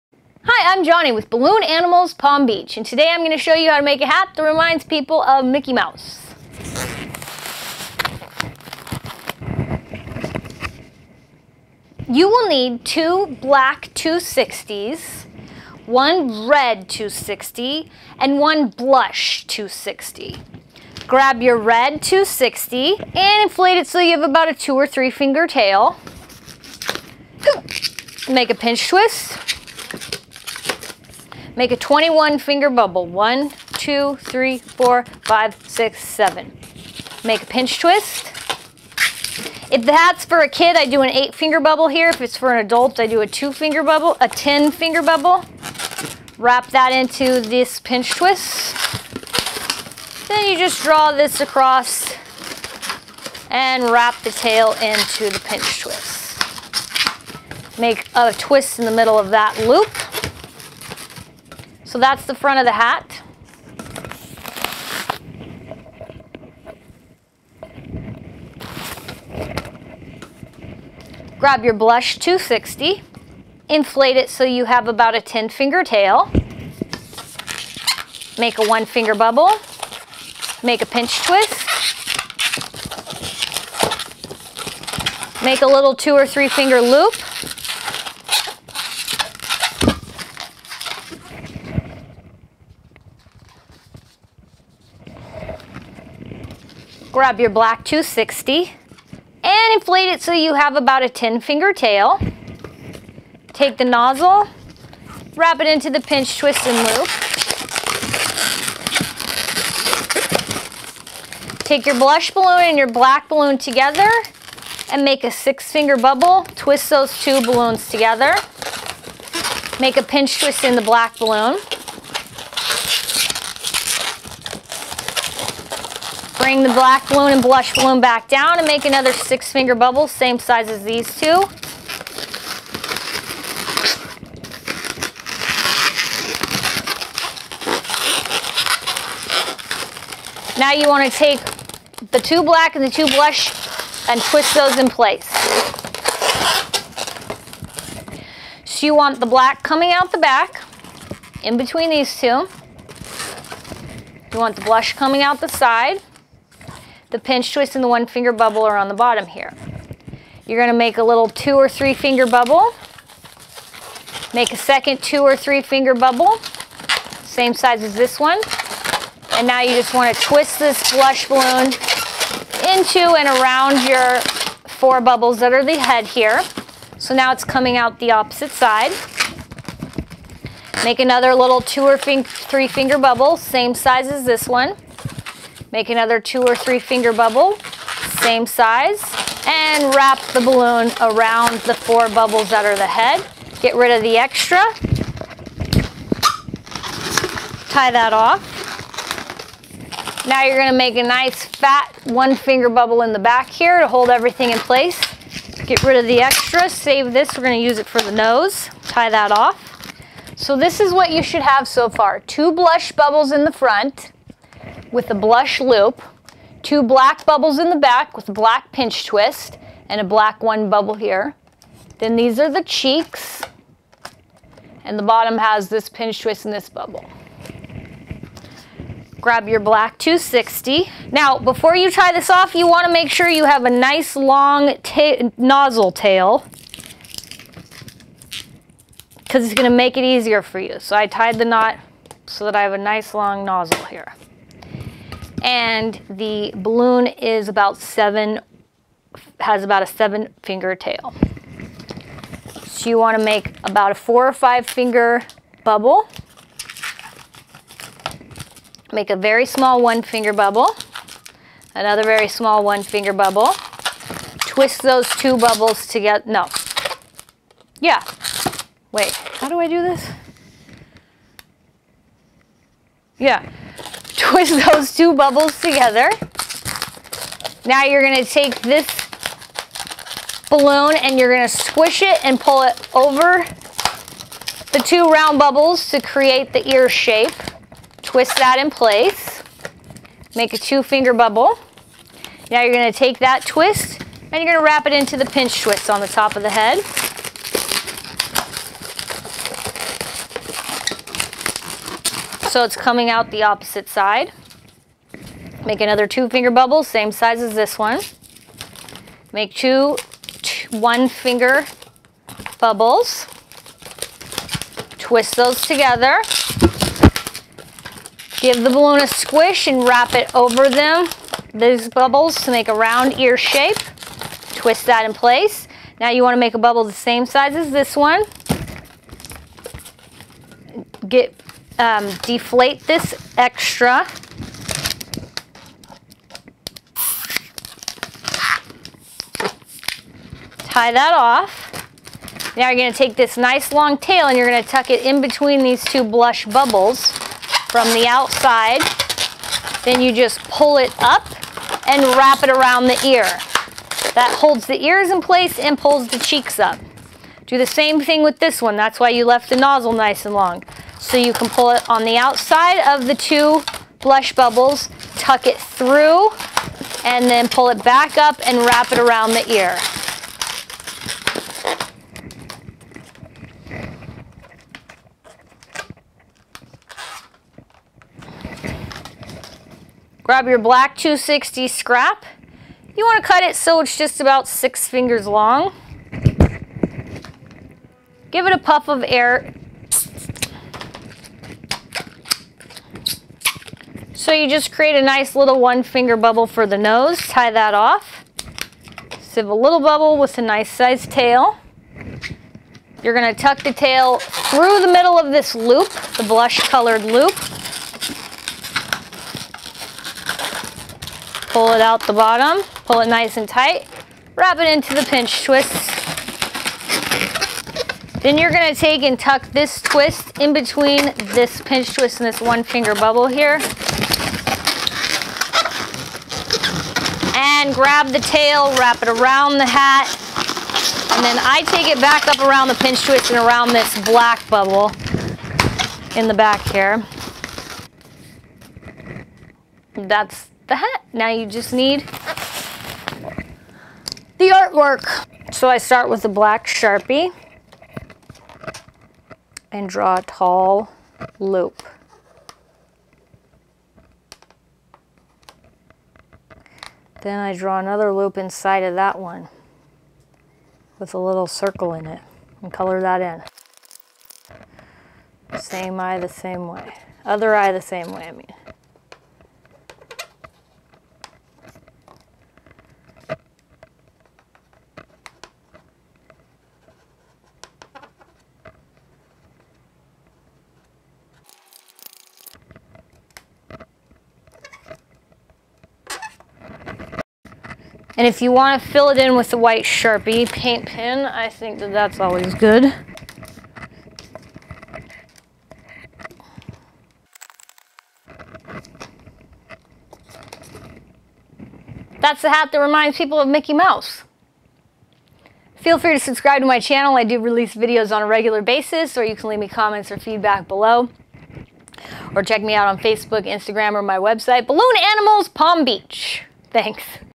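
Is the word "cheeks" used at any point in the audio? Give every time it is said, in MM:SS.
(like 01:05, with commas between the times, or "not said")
03:42, 05:56.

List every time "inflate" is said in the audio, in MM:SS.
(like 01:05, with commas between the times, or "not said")
00:23, 01:13, 01:39.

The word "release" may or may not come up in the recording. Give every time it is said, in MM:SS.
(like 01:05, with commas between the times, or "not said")
08:27.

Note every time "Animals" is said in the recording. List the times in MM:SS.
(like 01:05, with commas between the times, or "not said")
00:01, 08:35.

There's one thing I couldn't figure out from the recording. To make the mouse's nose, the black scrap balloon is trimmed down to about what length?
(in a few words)
6 fingers.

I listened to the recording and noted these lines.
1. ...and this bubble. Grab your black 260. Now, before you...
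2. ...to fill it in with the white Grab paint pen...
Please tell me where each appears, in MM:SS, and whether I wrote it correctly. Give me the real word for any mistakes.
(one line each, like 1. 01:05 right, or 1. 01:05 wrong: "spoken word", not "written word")
1. 03:46 right
2. 08:08 wrong: "Sharpie", not "Grab".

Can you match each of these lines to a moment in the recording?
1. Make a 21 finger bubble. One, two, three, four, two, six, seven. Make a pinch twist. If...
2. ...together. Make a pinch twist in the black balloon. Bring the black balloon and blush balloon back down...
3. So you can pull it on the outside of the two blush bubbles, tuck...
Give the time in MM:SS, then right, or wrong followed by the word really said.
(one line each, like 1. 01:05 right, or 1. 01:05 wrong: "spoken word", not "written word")
1. 00:31 wrong: "five", not "two"
2. 01:57 right
3. 06:01 right.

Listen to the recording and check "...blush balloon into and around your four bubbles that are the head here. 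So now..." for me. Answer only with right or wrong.
right.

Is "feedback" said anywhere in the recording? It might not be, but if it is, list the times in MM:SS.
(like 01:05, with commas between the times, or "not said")
08:30.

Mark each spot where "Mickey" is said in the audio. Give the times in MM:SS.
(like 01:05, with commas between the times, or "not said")
00:05, 08:23.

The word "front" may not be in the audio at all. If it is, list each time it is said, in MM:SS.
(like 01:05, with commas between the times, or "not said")
01:02, 03:33.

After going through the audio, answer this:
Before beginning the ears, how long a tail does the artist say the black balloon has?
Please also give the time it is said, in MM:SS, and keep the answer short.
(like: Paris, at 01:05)
7 fingers, at 04:09.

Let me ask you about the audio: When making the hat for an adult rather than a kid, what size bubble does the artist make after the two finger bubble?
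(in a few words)
10 finger bubble.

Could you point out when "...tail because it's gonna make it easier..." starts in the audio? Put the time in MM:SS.
03:55.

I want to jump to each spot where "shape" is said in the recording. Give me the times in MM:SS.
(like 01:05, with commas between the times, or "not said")
04:46, 05:23.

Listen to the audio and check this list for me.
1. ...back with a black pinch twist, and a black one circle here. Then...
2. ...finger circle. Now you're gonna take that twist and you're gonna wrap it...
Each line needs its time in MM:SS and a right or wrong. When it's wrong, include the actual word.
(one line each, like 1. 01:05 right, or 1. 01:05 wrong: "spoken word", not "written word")
1. 03:37 wrong: "bubble", not "circle"
2. 04:50 wrong: "bubble", not "circle".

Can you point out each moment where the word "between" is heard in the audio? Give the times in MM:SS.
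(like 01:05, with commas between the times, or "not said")
02:31, 05:45, 07:00.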